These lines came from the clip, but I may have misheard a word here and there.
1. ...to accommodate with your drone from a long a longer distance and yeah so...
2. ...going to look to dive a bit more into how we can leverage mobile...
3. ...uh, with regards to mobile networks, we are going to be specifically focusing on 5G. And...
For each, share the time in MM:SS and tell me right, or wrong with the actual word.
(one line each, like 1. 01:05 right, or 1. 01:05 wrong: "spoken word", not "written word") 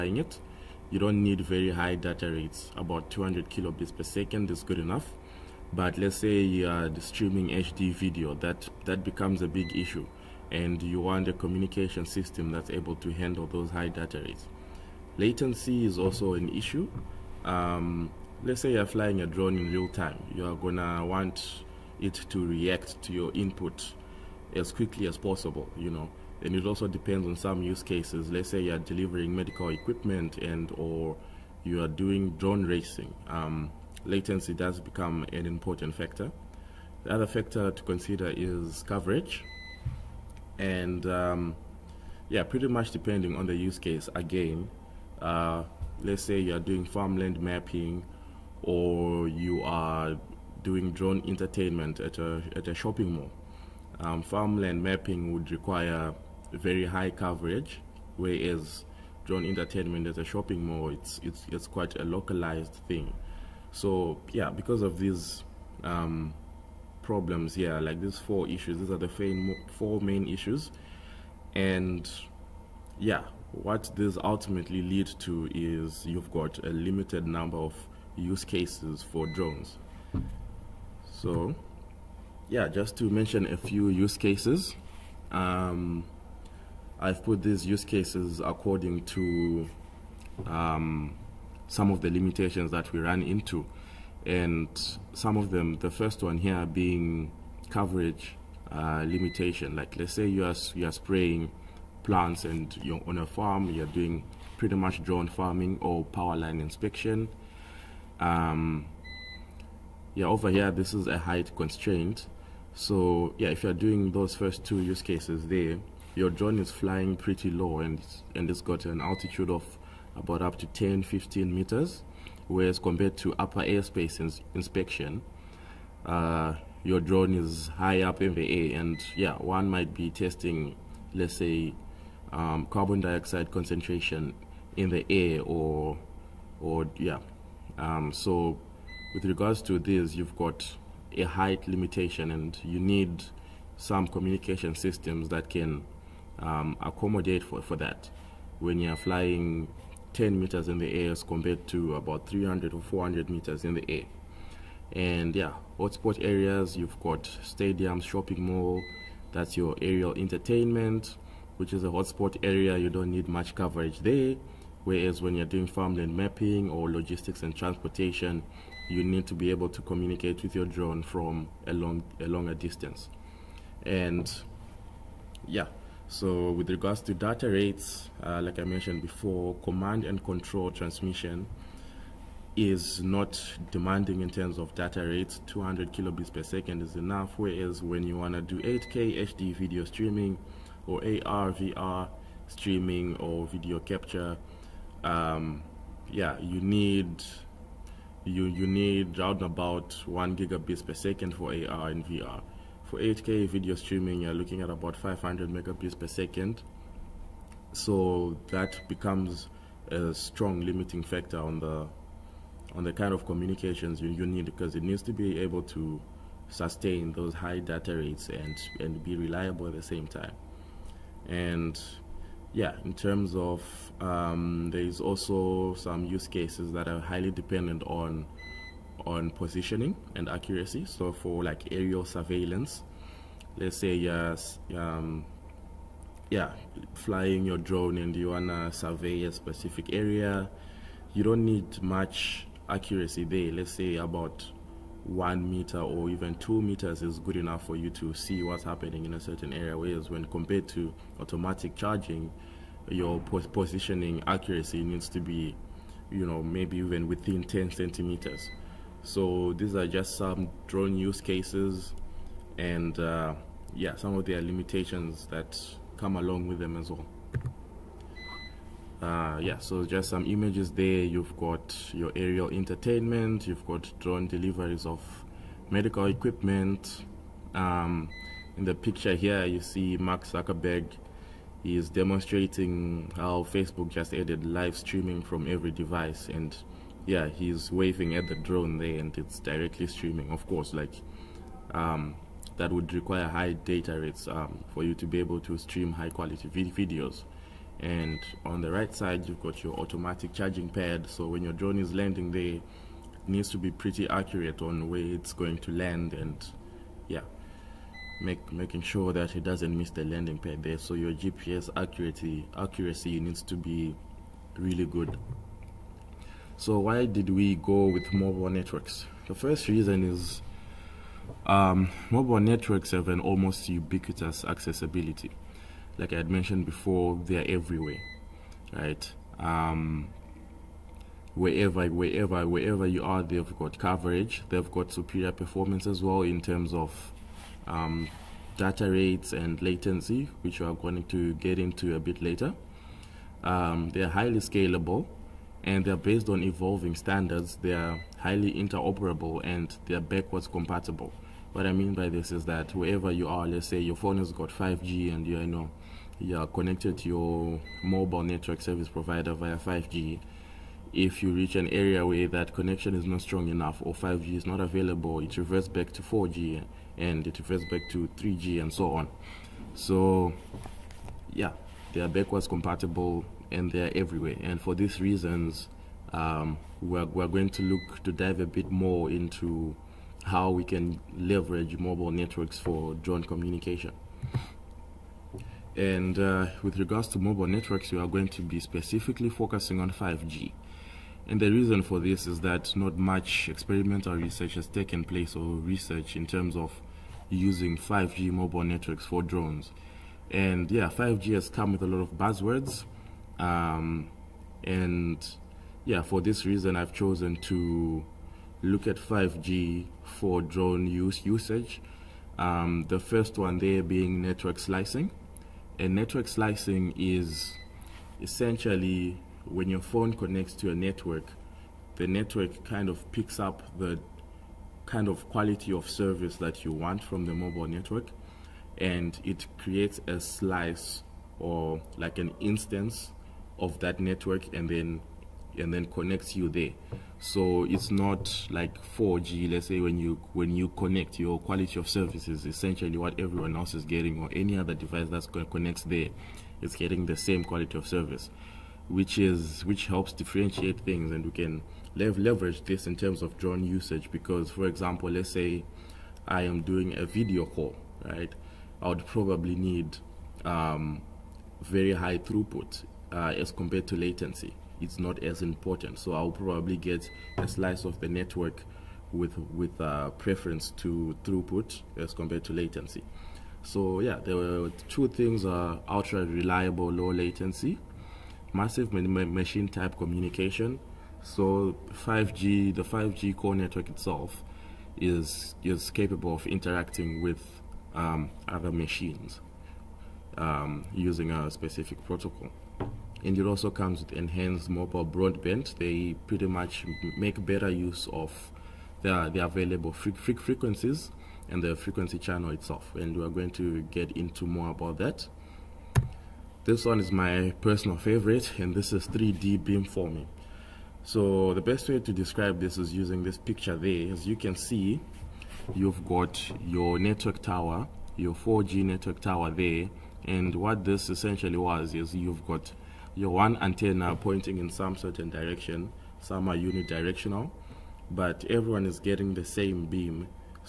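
1. 02:49 wrong: "communicate", not "accommodate"
2. 06:17 right
3. 06:26 right.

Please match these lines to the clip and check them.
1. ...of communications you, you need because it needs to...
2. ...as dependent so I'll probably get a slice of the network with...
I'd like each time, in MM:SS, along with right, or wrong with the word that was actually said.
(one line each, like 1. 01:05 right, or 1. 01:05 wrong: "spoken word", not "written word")
1. 03:33 right
2. 07:45 wrong: "important", not "dependent".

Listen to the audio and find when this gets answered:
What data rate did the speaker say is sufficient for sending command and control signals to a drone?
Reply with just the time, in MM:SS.
00:02.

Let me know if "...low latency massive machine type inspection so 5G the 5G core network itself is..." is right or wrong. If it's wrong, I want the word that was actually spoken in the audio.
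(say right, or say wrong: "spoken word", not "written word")
wrong: "communication", not "inspection".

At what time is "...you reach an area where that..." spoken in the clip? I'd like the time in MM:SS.
06:01.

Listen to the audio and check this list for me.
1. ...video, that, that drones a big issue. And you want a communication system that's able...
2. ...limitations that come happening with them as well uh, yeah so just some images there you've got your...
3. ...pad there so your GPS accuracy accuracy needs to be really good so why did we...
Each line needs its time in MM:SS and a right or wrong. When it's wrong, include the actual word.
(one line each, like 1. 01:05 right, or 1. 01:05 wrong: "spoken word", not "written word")
1. 00:07 wrong: "becomes", not "drones"
2. 04:24 wrong: "along", not "happening"
3. 05:10 right.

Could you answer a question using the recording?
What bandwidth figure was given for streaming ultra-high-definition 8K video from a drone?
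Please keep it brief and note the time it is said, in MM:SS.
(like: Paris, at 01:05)
500 megabits per second, at 03:24.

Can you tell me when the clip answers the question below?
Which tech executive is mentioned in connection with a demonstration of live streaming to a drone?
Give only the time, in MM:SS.
04:39.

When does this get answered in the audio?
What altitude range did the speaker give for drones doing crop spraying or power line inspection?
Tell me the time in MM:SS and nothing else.
02:00.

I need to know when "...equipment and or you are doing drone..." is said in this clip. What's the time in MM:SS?
00:29.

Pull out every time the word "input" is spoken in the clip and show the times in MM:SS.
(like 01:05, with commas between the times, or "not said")
00:23.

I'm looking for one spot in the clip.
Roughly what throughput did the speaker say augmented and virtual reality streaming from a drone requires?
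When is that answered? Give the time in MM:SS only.
03:20.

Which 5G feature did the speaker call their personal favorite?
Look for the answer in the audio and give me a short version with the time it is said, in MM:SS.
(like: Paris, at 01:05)
3D beamforming, at 08:29.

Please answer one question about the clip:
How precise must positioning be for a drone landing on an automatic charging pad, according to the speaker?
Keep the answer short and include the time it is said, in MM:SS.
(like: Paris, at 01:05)
10 centimeters, at 04:17.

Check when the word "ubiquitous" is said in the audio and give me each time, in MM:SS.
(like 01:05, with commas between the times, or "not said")
05:23.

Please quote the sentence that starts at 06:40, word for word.
And yeah, 5G has come with a lot of buzzwords.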